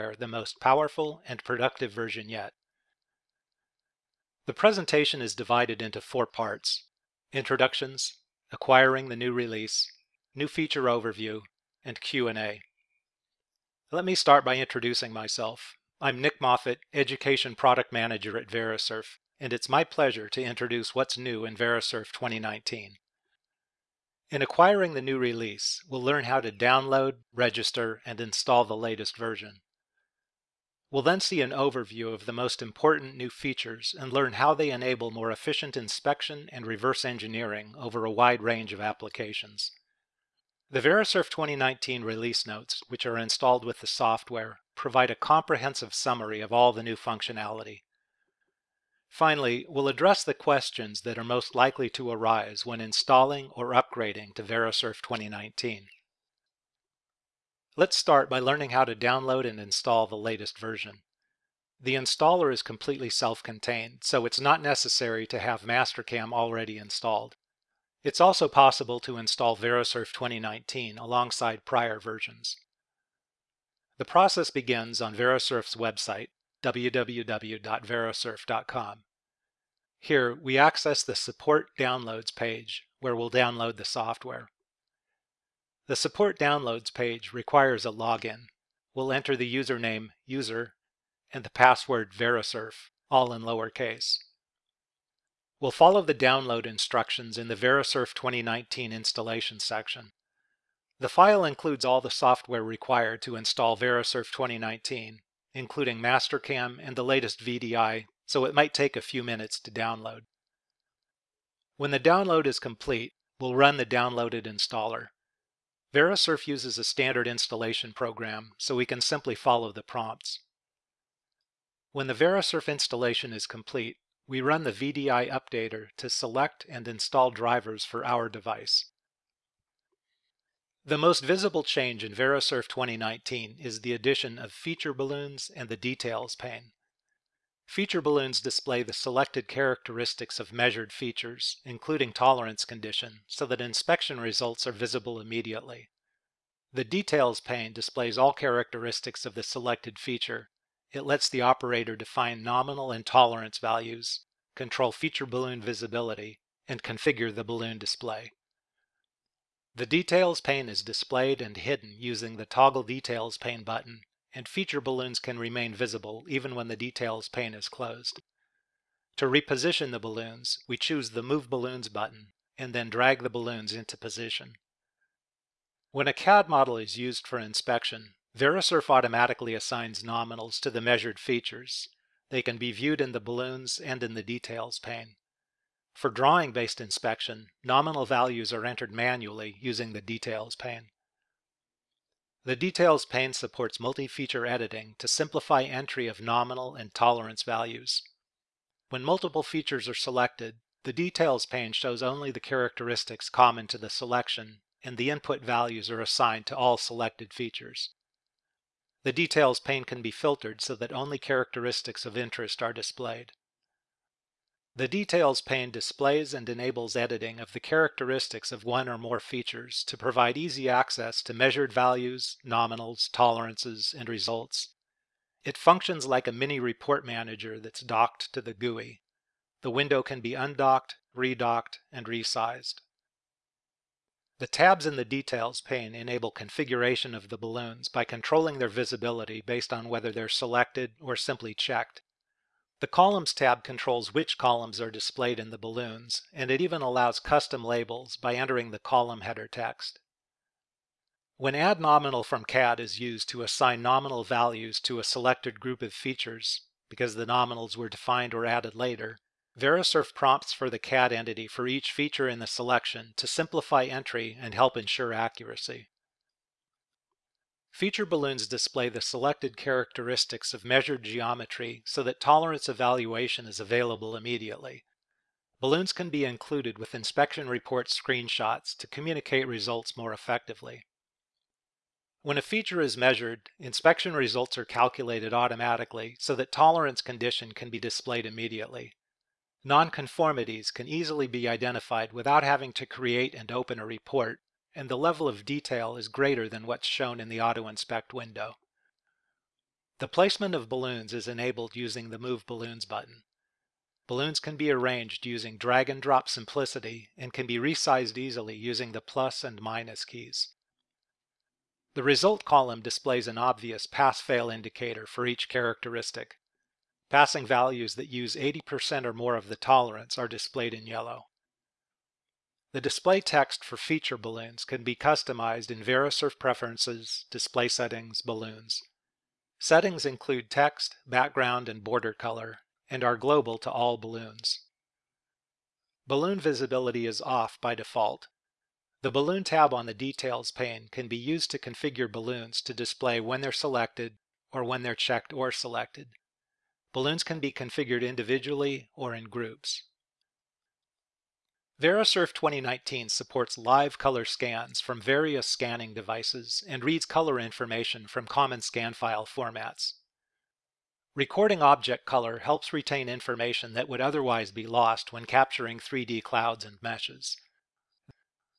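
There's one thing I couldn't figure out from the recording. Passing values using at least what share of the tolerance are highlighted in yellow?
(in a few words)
80%.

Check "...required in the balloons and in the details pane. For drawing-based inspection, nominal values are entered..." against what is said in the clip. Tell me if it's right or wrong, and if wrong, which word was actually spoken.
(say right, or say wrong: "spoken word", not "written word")
wrong: "viewed", not "required".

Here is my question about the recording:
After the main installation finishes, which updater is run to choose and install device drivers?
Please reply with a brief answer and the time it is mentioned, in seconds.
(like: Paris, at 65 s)
VDI updater, at 124 s.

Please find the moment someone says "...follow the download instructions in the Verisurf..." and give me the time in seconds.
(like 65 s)
95 s.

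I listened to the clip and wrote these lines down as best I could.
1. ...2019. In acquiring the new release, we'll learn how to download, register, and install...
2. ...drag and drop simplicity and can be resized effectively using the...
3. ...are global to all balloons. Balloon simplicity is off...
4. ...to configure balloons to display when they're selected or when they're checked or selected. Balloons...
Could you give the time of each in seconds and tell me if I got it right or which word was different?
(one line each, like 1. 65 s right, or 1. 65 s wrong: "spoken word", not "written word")
1. 22 s right
2. 305 s wrong: "easily", not "effectively"
3. 333 s wrong: "visibility", not "simplicity"
4. 341 s right.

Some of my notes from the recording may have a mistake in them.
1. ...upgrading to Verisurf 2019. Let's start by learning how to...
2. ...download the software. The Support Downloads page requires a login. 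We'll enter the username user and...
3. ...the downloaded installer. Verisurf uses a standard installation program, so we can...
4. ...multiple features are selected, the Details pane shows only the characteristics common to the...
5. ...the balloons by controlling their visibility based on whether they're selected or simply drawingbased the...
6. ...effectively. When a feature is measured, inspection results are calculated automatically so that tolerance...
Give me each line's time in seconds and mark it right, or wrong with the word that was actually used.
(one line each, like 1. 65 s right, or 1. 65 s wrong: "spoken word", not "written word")
1. 53 s right
2. 83 s right
3. 113 s right
4. 199 s right
5. 237 s wrong: "checked", not "drawingbased"
6. 280 s right.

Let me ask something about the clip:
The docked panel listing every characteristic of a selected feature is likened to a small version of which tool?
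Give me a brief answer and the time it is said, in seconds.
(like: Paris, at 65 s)
report manager, at 226 s.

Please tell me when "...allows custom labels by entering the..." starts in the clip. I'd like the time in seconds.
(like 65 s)
246 s.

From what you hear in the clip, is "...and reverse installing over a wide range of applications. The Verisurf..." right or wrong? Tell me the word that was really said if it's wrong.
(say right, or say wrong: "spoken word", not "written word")
wrong: "engineering", not "installing".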